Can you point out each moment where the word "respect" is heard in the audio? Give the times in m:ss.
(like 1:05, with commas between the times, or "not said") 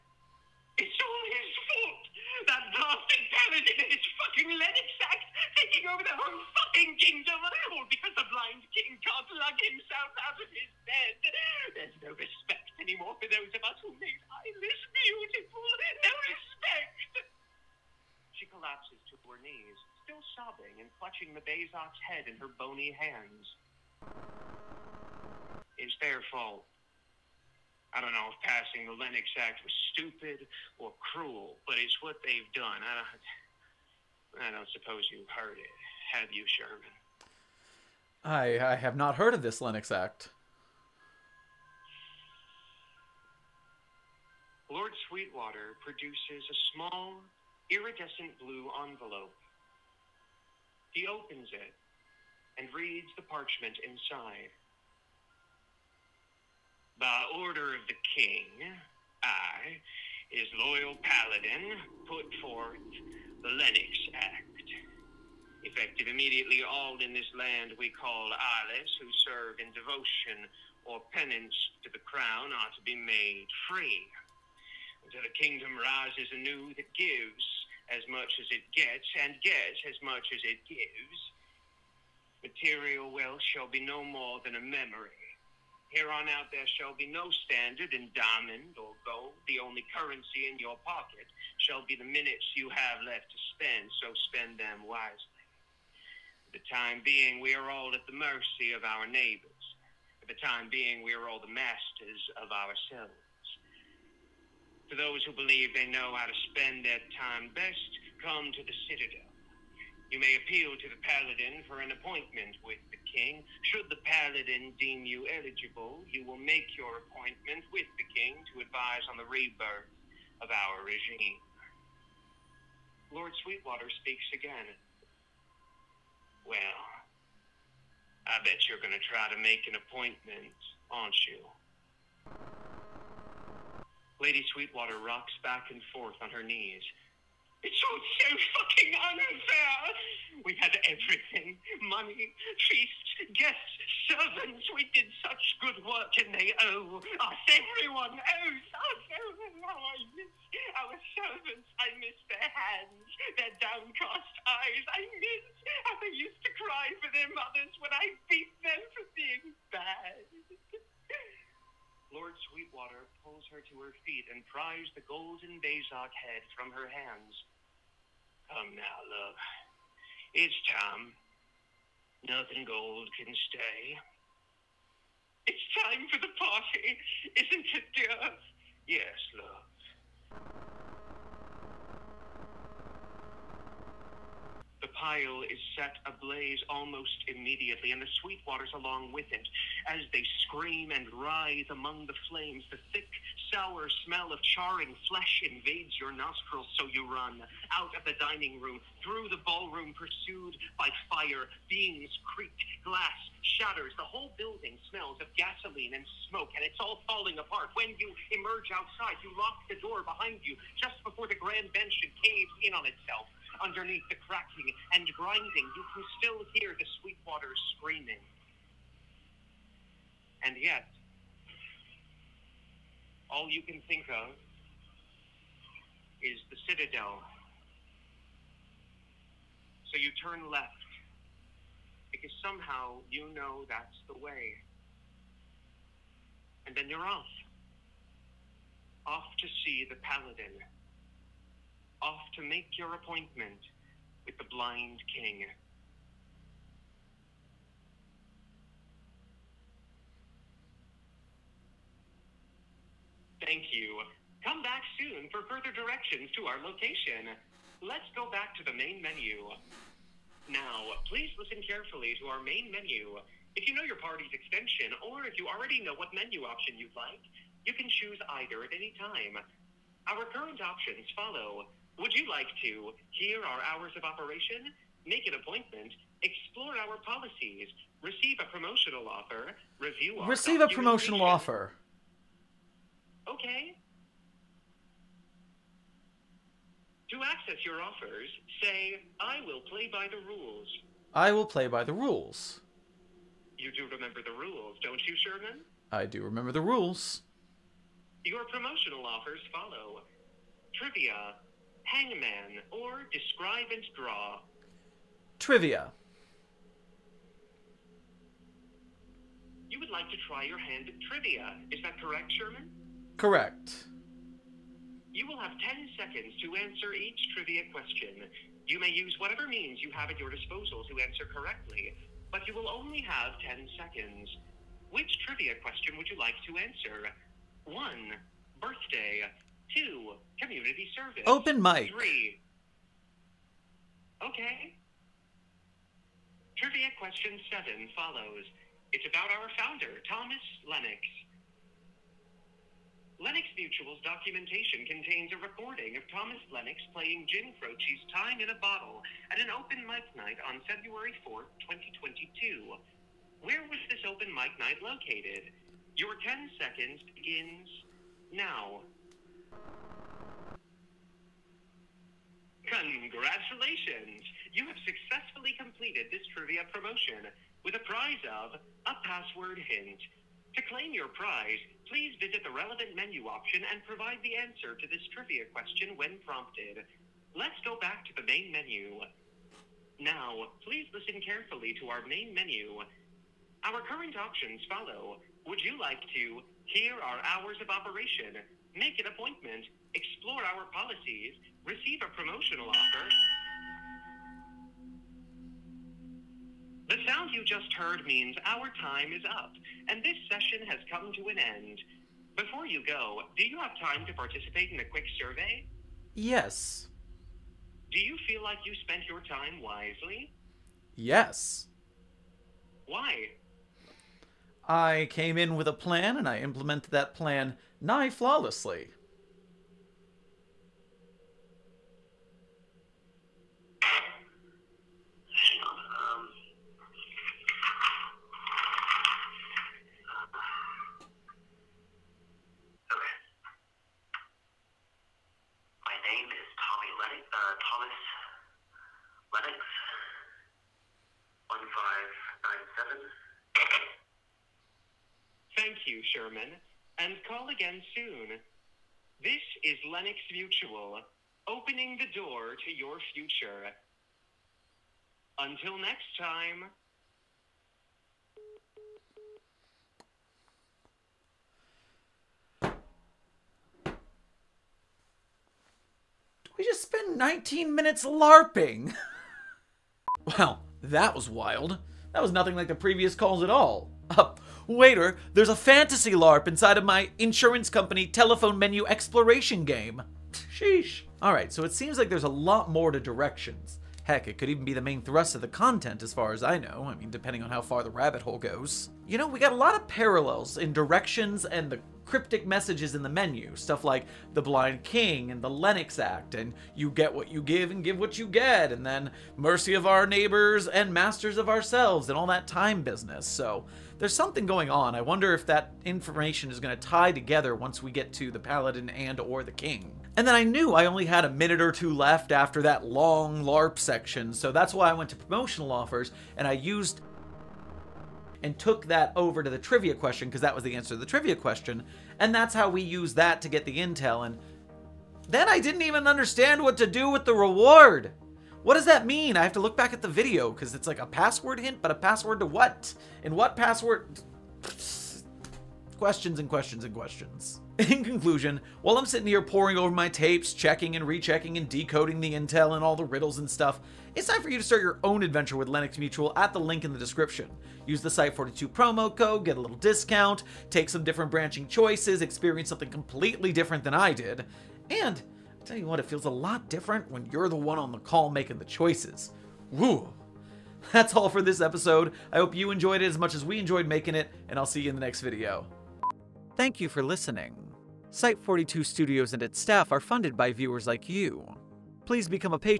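0:12, 0:16.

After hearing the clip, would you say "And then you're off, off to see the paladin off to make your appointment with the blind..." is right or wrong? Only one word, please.
right.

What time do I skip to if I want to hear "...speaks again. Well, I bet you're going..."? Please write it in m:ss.
2:04.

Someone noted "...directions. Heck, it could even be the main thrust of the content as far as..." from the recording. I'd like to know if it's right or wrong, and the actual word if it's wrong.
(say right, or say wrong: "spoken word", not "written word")
right.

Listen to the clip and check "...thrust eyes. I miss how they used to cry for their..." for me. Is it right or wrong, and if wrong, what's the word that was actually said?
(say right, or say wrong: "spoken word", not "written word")
wrong: "downcast", not "thrust".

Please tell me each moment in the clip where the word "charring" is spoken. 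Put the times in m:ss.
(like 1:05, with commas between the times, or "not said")
3:14.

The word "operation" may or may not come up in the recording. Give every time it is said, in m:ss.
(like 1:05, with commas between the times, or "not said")
4:34, 6:27.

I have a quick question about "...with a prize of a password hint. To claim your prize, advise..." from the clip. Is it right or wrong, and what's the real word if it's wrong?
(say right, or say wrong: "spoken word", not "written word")
wrong: "please", not "advise".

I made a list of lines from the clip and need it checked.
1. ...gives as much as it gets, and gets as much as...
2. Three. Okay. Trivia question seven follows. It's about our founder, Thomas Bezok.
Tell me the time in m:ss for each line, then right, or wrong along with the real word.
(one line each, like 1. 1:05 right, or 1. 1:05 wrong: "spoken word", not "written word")
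1. 1:16 right
2. 5:31 wrong: "Lennox", not "Bezok".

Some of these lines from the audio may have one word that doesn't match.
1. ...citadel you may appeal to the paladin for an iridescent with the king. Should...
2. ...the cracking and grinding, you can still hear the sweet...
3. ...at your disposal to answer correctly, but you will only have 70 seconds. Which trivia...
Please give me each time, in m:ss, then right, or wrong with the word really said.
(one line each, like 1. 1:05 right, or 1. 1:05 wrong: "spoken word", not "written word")
1. 1:48 wrong: "appointment", not "iridescent"
2. 3:34 right
3. 5:20 wrong: "10", not "70".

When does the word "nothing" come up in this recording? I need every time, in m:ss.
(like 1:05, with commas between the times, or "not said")
2:52, 7:52.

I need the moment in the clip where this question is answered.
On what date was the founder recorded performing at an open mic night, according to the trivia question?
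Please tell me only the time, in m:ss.
5:50.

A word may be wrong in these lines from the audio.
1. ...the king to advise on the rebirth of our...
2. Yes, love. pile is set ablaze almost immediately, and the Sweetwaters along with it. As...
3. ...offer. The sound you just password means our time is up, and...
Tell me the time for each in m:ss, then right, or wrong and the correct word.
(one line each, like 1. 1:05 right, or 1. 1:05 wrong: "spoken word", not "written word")
1. 1:57 right
2. 2:58 right
3. 6:32 wrong: "heard", not "password".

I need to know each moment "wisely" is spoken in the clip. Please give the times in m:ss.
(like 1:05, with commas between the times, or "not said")
1:34, 6:49.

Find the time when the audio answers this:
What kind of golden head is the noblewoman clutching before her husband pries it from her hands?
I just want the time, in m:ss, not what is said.
2:45.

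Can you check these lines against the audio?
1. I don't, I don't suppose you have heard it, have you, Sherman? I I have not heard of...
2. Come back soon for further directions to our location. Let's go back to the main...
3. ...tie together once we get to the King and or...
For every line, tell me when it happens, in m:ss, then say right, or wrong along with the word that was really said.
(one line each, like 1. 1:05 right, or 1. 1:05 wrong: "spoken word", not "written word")
1. 0:32 right
2. 4:14 right
3. 8:26 wrong: "Paladin", not "King".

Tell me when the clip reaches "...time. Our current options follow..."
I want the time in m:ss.
4:28.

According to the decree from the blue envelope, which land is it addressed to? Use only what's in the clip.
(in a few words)
Ilus.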